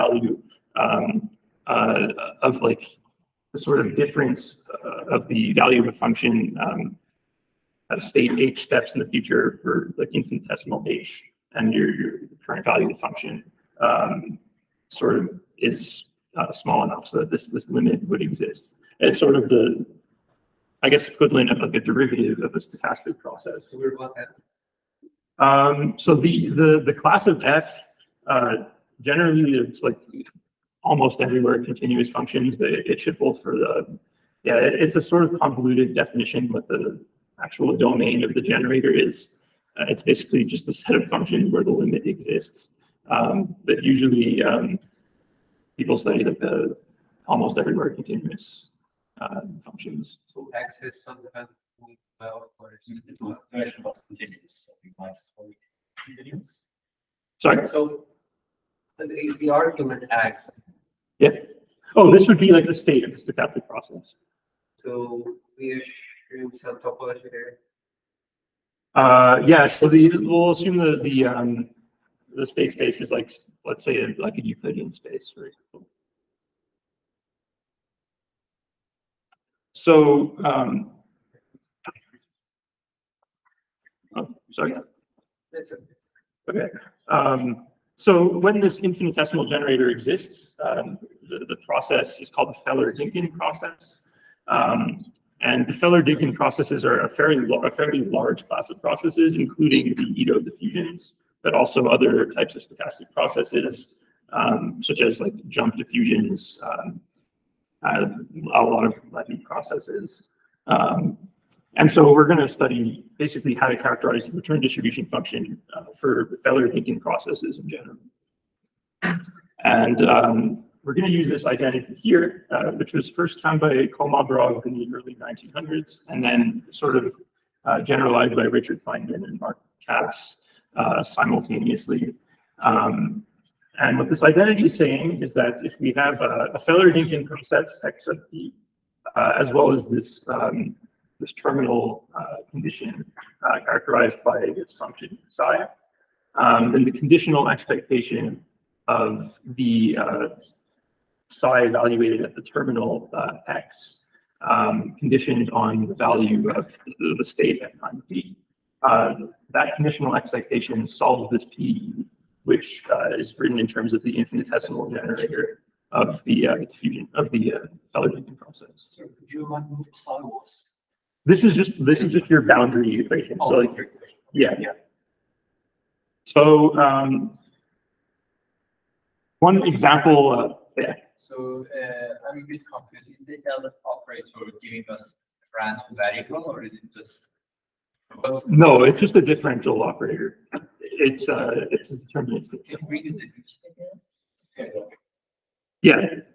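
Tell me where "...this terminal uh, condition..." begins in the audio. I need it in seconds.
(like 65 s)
141 s.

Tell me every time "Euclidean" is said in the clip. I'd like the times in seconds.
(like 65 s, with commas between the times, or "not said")
74 s.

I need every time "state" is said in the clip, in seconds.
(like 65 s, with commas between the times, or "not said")
8 s, 62 s, 72 s, 157 s.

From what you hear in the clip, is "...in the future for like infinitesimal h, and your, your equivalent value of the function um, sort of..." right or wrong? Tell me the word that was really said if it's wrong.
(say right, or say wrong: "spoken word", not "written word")
wrong: "current", not "equivalent".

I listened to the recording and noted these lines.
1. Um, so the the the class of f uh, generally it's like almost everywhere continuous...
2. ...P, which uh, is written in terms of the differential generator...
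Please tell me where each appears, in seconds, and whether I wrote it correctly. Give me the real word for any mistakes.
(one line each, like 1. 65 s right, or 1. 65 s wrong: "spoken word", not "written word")
1. 25 s right
2. 161 s wrong: "infinitesimal", not "differential".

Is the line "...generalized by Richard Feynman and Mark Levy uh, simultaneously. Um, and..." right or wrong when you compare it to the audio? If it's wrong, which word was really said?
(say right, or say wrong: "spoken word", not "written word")
wrong: "Kac", not "Levy".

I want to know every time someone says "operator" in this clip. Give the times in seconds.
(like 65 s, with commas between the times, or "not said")
183 s, 189 s.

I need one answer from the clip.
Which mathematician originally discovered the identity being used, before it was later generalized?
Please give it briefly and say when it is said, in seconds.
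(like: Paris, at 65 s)
Kolmogorov, at 123 s.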